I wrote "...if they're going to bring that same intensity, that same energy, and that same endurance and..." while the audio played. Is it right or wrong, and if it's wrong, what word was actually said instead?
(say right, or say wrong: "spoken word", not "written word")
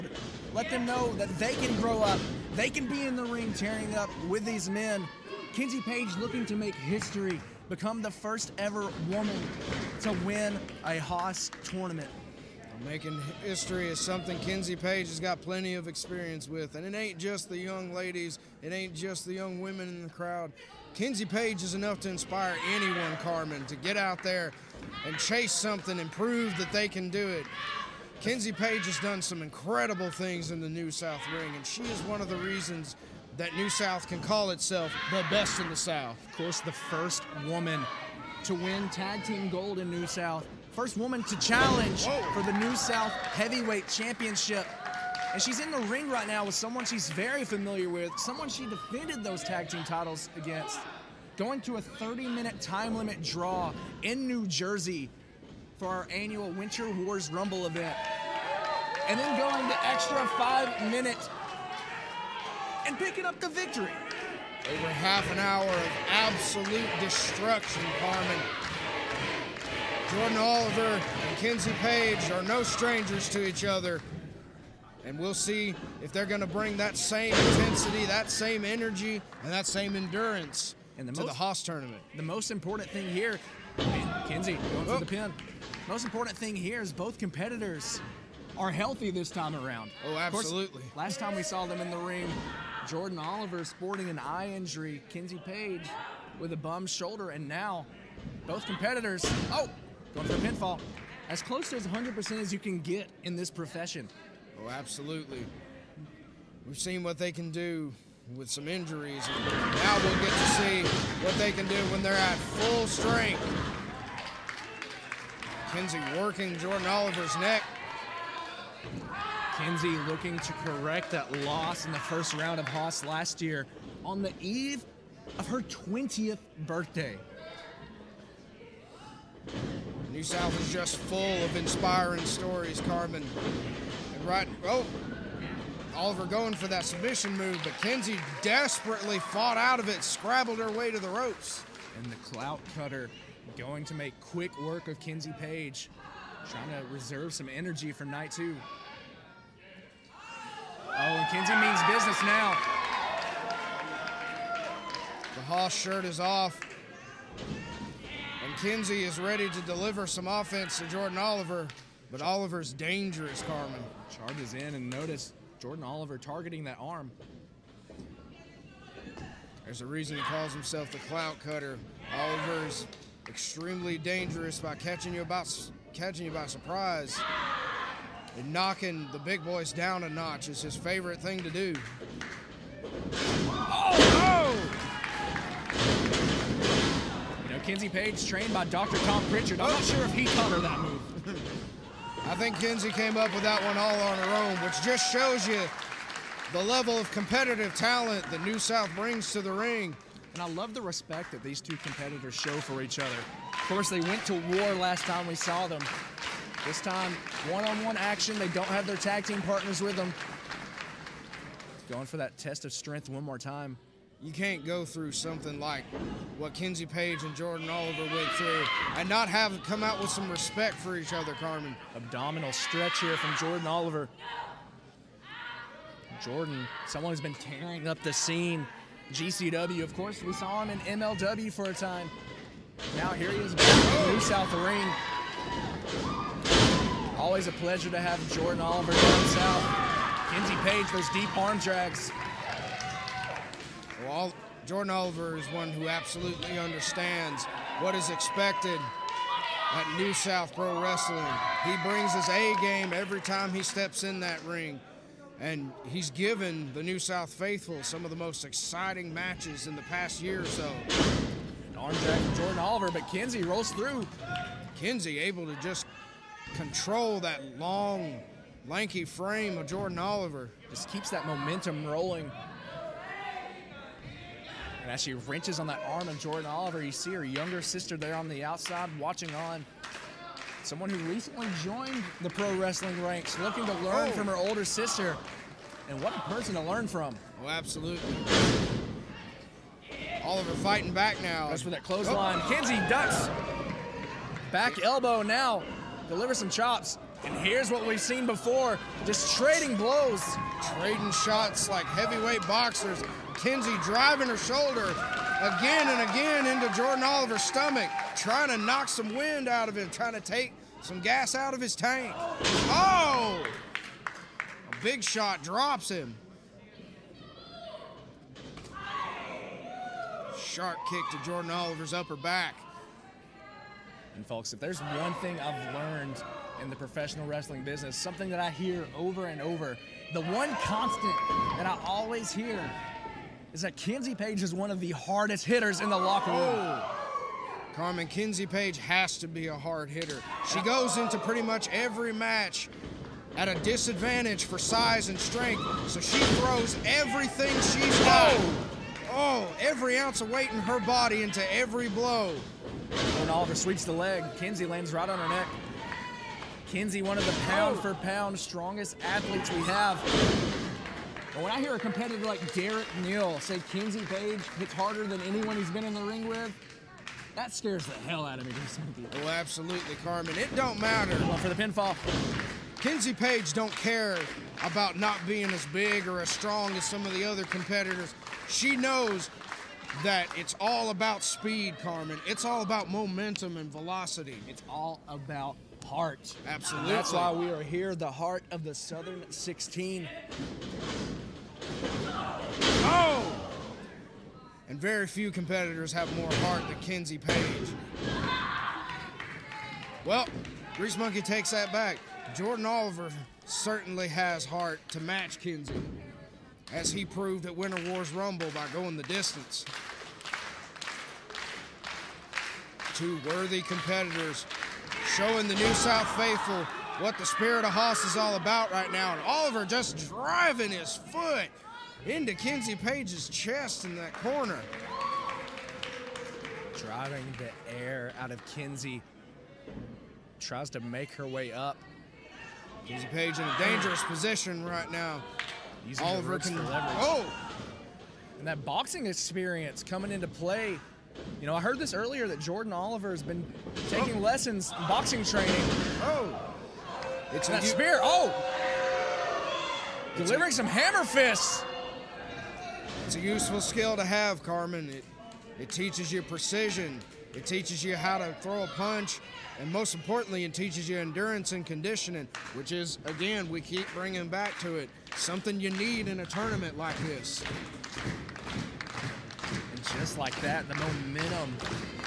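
right.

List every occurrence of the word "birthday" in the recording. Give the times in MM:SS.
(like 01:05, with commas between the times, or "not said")
02:06.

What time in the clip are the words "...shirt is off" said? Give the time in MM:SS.
02:35.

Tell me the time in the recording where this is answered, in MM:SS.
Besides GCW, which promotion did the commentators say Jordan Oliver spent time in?
03:50.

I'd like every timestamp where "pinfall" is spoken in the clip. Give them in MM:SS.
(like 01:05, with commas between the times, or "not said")
01:40, 06:11.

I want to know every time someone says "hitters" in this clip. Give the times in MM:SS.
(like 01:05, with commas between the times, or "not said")
05:35, 05:39.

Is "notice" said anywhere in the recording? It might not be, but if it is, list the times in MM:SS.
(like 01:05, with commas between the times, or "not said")
02:44.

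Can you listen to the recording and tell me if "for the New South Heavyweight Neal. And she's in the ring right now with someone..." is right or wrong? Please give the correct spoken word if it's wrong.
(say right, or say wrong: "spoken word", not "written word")
wrong: "Championship", not "Neal".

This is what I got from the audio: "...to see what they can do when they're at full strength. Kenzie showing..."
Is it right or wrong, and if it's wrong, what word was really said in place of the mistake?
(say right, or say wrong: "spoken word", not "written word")
wrong: "working", not "showing".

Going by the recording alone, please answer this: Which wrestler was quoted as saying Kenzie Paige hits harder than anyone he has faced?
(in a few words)
Derek Neal.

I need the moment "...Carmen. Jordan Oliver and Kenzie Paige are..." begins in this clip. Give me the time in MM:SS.
01:08.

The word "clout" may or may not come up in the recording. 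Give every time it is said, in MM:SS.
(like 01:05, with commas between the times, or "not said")
02:22, 02:51.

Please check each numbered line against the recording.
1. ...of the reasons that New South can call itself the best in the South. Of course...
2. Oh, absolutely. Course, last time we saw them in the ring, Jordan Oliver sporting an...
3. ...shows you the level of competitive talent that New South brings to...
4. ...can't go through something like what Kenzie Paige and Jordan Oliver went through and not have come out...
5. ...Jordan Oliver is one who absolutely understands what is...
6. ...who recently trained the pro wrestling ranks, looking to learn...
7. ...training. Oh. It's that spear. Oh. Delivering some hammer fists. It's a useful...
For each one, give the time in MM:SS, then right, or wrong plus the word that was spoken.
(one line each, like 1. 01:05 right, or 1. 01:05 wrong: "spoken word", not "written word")
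1. 00:32 right
2. 01:30 right
3. 03:15 right
4. 03:34 right
5. 04:04 right
6. 04:40 wrong: "joined", not "trained"
7. 07:25 right.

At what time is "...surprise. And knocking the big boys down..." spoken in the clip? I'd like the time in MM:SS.
02:56.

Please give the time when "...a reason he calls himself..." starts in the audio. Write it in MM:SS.
02:49.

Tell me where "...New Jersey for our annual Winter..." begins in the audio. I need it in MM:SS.
00:54.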